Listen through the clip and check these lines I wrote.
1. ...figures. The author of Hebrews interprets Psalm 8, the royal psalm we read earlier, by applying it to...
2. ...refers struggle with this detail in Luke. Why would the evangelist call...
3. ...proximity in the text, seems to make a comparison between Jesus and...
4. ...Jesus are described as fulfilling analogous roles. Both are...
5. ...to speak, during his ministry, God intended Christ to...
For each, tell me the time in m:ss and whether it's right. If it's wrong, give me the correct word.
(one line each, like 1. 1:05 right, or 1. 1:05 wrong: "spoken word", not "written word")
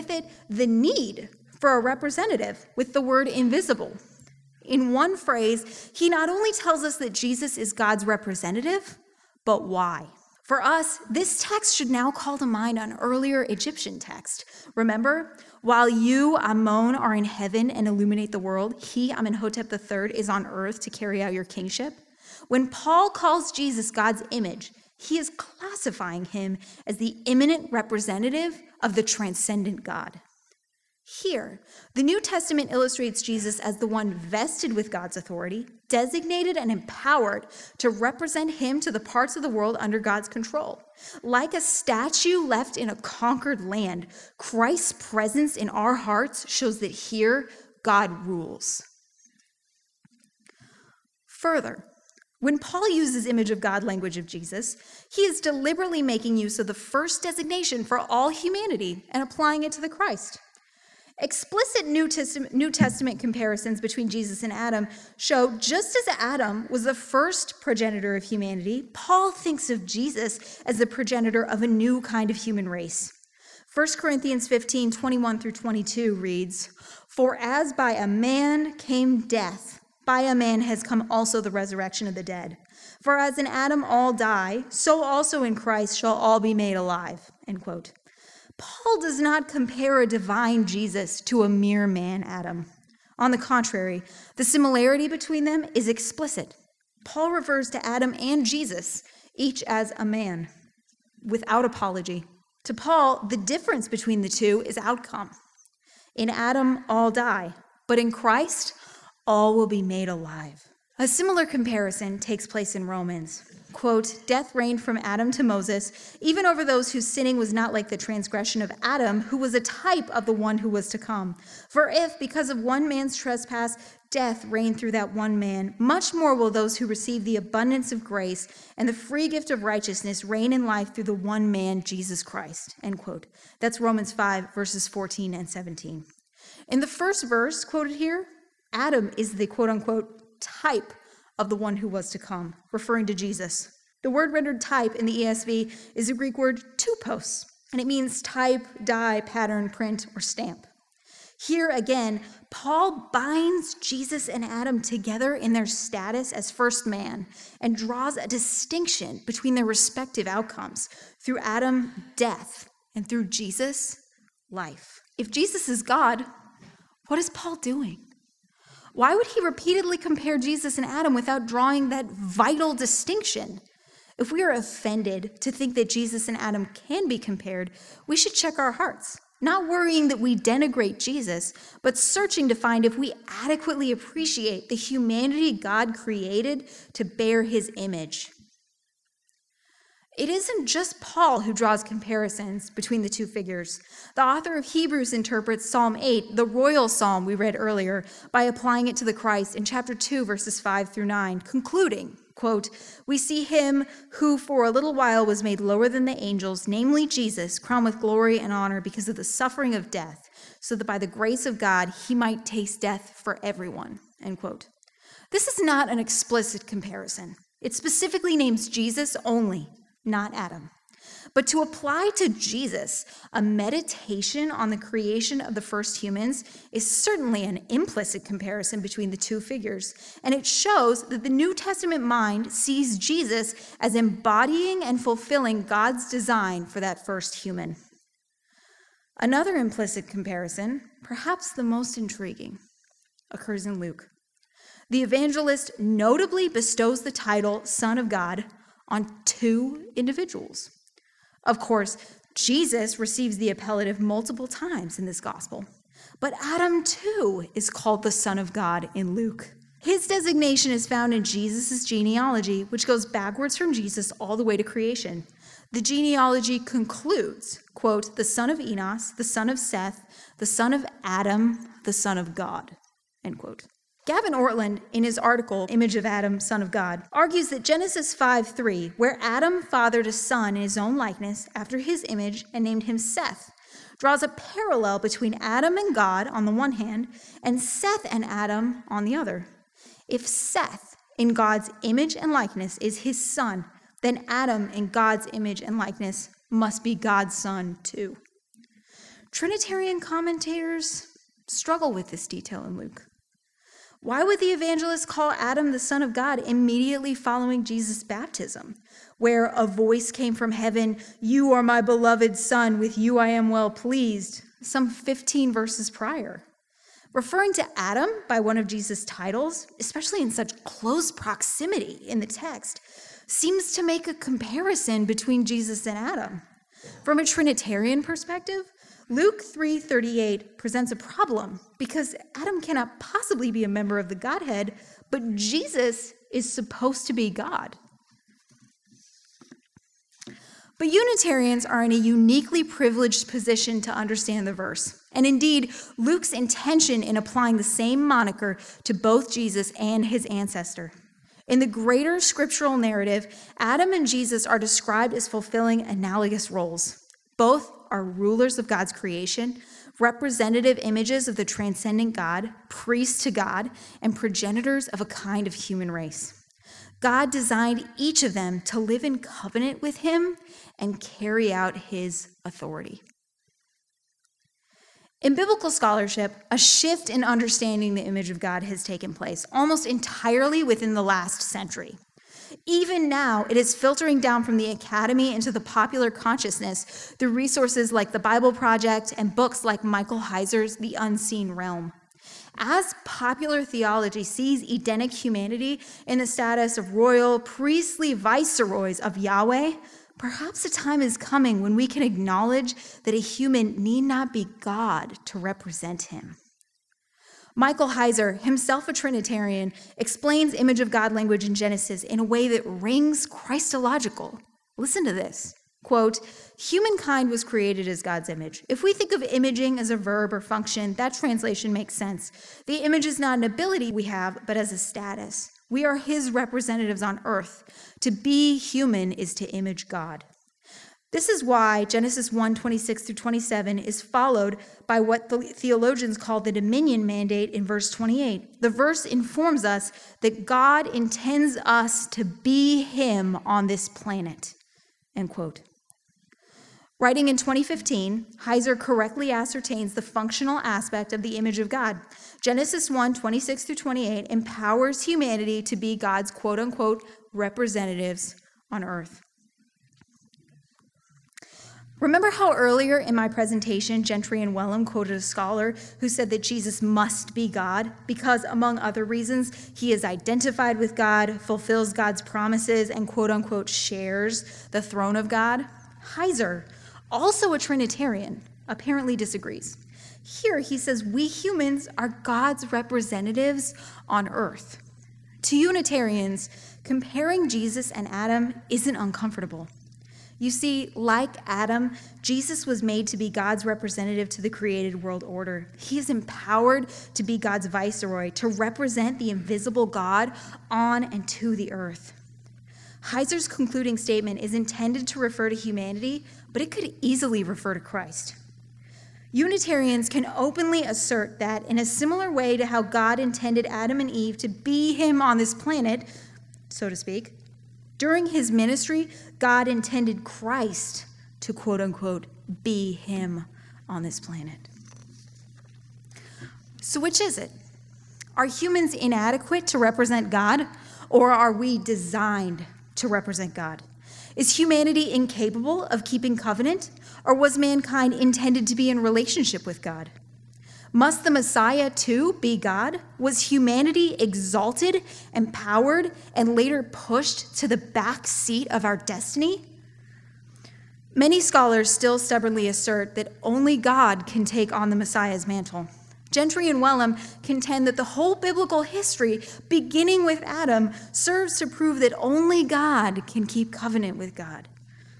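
1. 3:13 right
2. 5:00 wrong: "commentators", not "refers"
3. 5:21 right
4. 5:54 right
5. 8:36 right.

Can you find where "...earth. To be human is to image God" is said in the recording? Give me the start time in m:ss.
7:07.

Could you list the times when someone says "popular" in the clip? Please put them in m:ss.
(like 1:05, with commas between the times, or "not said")
6:25, 6:33.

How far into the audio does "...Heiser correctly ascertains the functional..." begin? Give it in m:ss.
7:28.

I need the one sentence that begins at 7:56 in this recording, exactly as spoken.
Heiser, also a Trinitarian, apparently disagrees.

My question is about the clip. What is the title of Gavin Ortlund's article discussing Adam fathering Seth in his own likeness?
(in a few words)
Image of Adam, Son of God.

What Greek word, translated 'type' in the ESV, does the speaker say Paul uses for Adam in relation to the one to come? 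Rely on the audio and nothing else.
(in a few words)
tupos.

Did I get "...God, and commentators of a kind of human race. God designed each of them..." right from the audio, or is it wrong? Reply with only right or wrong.
wrong.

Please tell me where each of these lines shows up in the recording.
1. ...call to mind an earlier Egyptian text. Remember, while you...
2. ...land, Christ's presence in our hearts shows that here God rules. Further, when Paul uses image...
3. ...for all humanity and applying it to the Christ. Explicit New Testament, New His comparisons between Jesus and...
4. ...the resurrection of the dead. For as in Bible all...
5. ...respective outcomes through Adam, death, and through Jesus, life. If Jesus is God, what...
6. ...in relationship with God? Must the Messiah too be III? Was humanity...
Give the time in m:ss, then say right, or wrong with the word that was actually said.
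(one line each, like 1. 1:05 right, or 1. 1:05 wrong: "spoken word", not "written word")
1. 0:12 right
2. 0:43 right
3. 0:57 wrong: "Testament", not "His"
4. 1:21 wrong: "Adam", not "Bible"
5. 2:39 right
6. 8:58 wrong: "God", not "III".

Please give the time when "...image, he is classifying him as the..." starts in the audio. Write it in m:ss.
0:24.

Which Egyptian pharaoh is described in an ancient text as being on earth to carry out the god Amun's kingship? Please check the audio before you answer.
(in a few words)
Amenhotep III.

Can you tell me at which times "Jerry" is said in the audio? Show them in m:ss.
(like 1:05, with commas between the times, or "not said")
not said.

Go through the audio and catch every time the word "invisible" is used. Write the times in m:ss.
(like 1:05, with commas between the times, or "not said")
0:03, 8:19.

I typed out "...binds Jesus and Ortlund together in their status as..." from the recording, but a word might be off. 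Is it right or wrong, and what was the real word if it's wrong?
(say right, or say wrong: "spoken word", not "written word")
wrong: "Adam", not "Ortlund".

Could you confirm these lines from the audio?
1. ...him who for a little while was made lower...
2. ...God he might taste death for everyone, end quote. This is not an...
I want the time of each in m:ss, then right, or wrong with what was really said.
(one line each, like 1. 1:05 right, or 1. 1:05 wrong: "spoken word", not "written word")
1. 3:23 right
2. 3:31 right.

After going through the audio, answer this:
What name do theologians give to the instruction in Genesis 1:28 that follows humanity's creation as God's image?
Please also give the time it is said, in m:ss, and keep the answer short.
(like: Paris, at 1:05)
dominion mandate, at 7:16.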